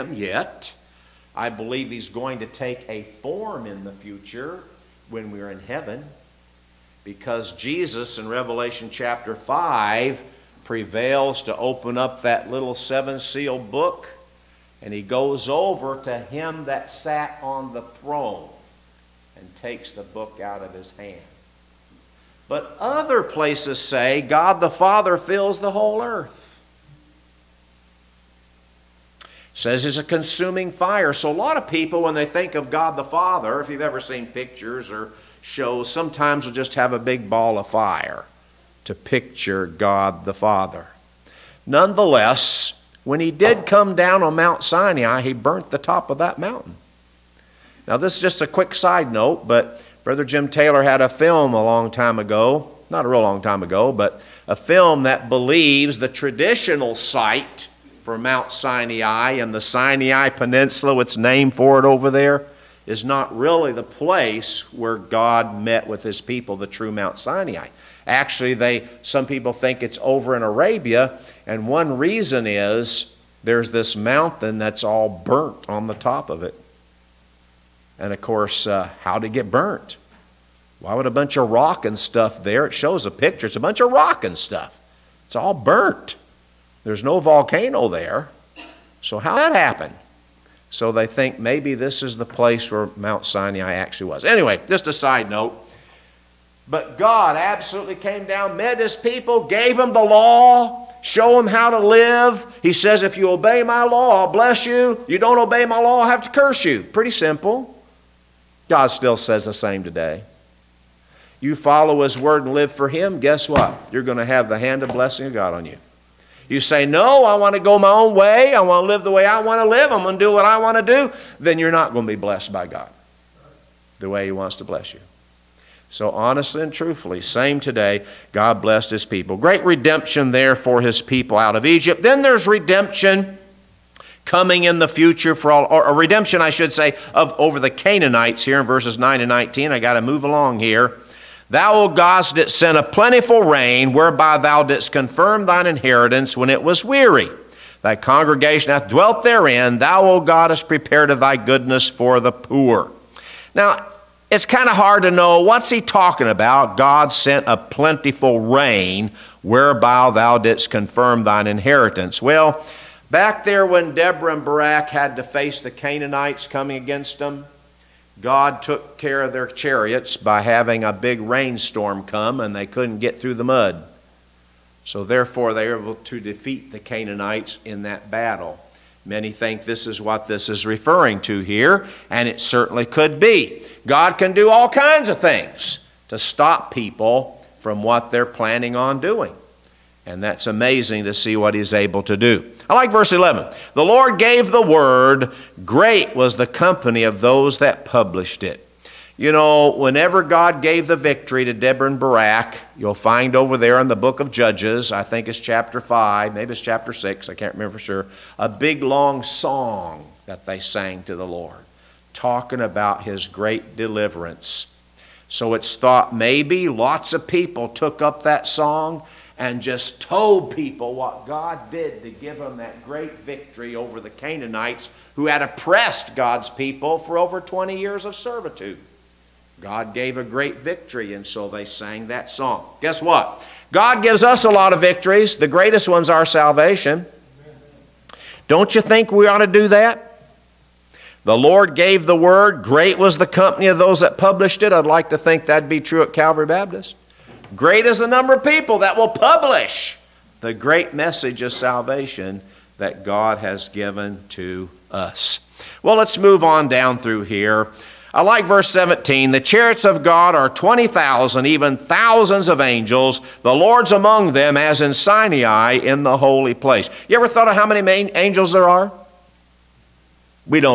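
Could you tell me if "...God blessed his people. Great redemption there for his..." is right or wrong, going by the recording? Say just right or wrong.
right.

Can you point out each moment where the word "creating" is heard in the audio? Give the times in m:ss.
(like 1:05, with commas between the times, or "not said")
not said.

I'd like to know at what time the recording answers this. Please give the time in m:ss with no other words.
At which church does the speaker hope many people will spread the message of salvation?
4:06.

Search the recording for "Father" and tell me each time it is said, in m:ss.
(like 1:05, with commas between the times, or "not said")
0:24, 0:33, 0:40.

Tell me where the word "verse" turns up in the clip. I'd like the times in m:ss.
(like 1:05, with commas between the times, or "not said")
2:18, 3:12, 4:18.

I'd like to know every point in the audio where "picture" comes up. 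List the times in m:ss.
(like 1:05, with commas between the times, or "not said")
0:34, 0:38, 1:23.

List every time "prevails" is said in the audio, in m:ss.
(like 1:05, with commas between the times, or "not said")
0:10.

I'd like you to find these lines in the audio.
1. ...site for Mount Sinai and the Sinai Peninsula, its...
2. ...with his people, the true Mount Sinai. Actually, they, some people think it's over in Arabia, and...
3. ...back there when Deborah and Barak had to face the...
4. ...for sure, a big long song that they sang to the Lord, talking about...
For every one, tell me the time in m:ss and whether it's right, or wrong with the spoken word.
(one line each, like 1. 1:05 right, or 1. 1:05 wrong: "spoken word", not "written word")
1. 0:56 right
2. 1:05 right
3. 2:43 right
4. 3:27 right.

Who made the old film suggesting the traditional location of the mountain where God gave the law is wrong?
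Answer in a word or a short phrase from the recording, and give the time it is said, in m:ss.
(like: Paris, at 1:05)
Jim Taylor, at 0:50.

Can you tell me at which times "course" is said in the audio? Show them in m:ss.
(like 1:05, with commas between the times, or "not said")
1:18.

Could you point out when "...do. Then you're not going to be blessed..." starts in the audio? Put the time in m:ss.
2:00.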